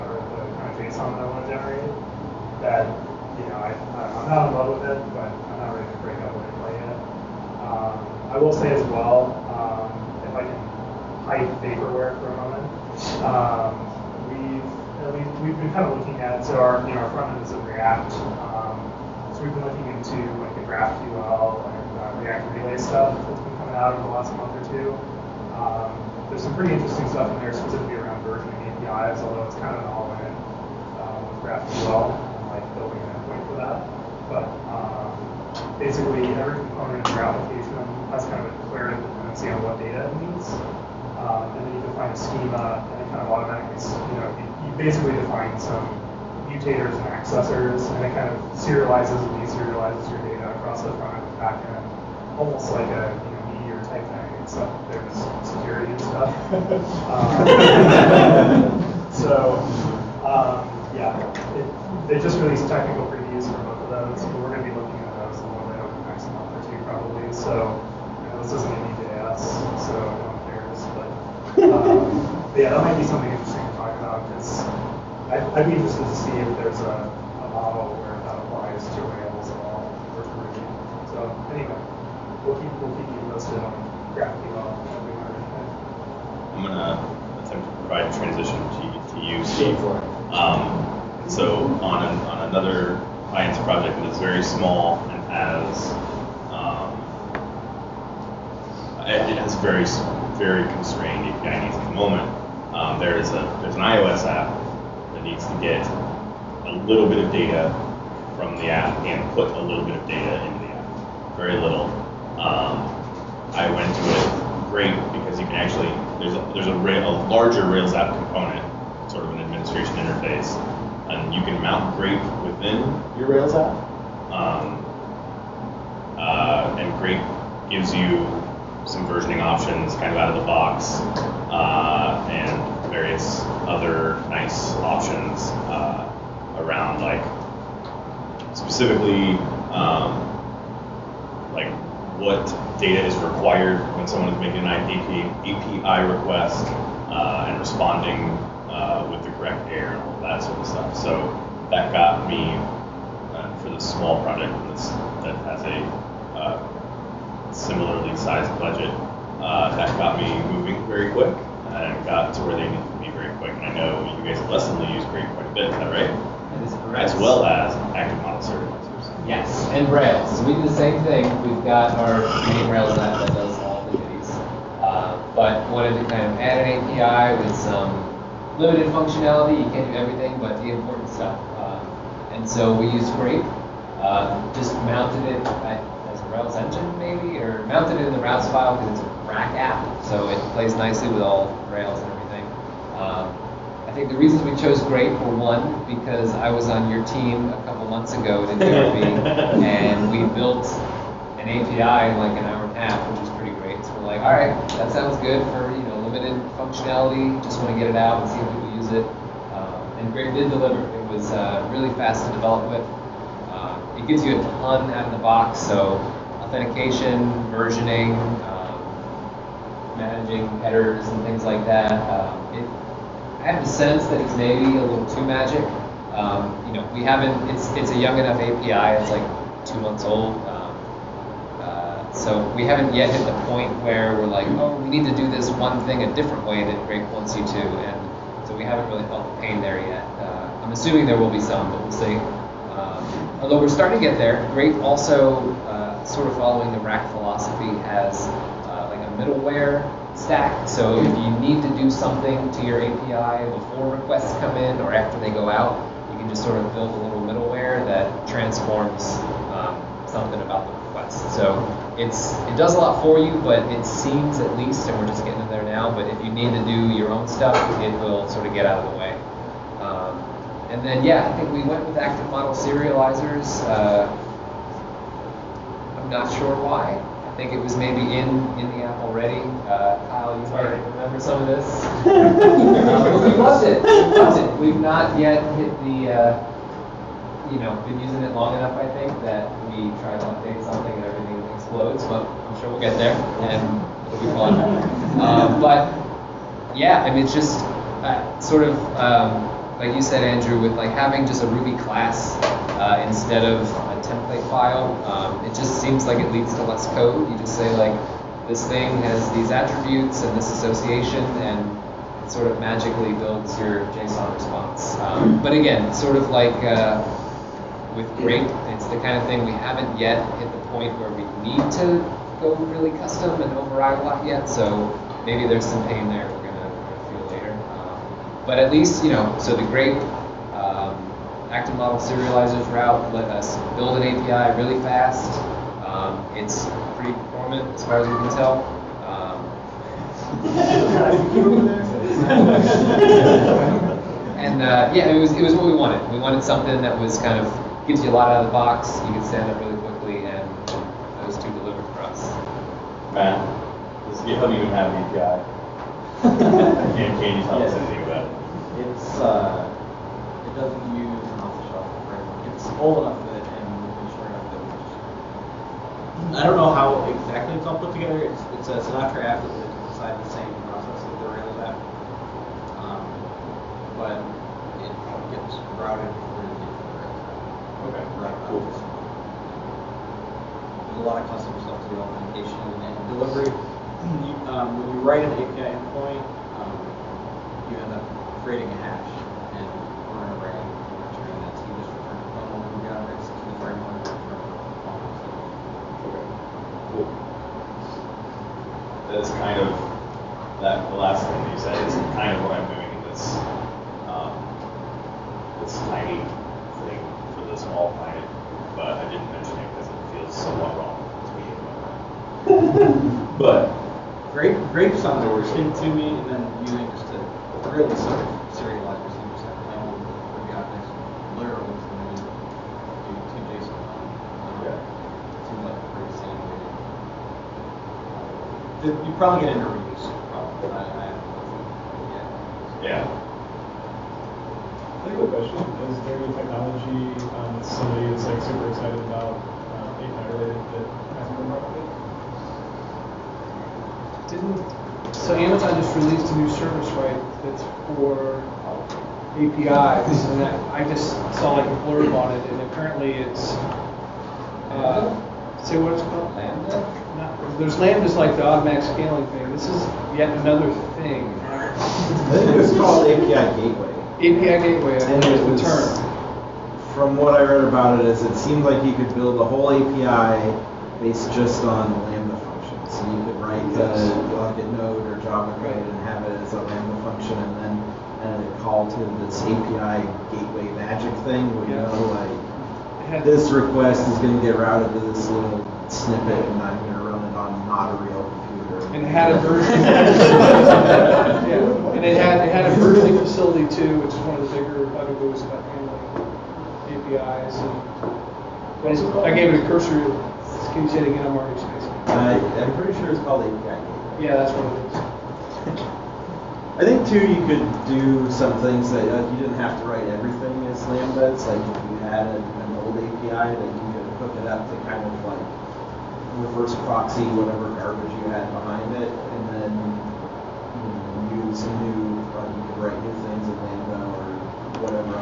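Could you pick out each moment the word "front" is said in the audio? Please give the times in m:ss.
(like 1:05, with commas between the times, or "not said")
0:17, 0:51.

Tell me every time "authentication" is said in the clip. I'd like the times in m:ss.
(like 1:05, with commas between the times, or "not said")
3:36, 6:22.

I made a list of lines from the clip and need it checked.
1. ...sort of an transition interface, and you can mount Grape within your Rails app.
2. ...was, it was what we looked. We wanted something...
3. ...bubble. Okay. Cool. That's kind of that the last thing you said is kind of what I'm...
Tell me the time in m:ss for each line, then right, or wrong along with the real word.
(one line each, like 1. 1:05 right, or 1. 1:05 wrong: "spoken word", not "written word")
1. 1:59 wrong: "administration", not "transition"
2. 5:45 wrong: "wanted", not "looked"
3. 6:34 right.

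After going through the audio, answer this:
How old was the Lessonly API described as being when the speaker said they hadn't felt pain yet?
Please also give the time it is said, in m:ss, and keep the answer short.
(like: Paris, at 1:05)
2 months, at 3:49.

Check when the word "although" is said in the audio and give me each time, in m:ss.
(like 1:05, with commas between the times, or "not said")
0:29, 4:03.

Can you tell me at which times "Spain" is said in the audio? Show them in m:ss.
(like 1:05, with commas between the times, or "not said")
not said.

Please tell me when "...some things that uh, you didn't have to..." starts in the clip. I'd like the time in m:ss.
8:28.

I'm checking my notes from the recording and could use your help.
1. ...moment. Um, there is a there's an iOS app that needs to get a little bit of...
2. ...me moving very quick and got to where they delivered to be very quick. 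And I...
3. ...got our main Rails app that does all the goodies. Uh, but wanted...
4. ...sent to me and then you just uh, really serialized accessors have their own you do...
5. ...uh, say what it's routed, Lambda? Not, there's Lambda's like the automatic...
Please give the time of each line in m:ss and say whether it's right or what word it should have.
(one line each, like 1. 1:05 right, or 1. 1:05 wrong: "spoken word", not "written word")
1. 1:41 right
2. 2:40 wrong: "needed", not "delivered"
3. 2:51 right
4. 6:55 wrong: "receivers", not "accessors"
5. 7:34 wrong: "called", not "routed".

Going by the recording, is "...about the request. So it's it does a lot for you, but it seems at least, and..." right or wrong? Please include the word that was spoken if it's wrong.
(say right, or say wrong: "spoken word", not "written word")
right.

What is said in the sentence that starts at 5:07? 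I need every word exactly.
You just say like, this thing has these attributes and this association, and it sort of magically builds your JSON response.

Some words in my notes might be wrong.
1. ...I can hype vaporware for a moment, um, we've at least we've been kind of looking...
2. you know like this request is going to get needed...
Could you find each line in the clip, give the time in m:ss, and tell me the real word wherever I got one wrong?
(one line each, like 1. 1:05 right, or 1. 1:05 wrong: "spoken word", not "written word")
1. 0:10 right
2. 8:01 wrong: "routed", not "needed".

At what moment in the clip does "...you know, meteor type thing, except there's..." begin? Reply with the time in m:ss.
0:53.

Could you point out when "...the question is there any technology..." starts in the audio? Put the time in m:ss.
7:15.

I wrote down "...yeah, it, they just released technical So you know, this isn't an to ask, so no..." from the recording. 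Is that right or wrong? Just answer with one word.
right.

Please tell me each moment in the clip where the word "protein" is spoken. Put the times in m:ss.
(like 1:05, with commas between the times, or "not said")
not said.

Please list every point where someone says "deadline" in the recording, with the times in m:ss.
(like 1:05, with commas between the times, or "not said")
not said.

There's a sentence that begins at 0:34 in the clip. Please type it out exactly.
But um, basically, every component of your application has kind of a declarative dependency on what data it needs.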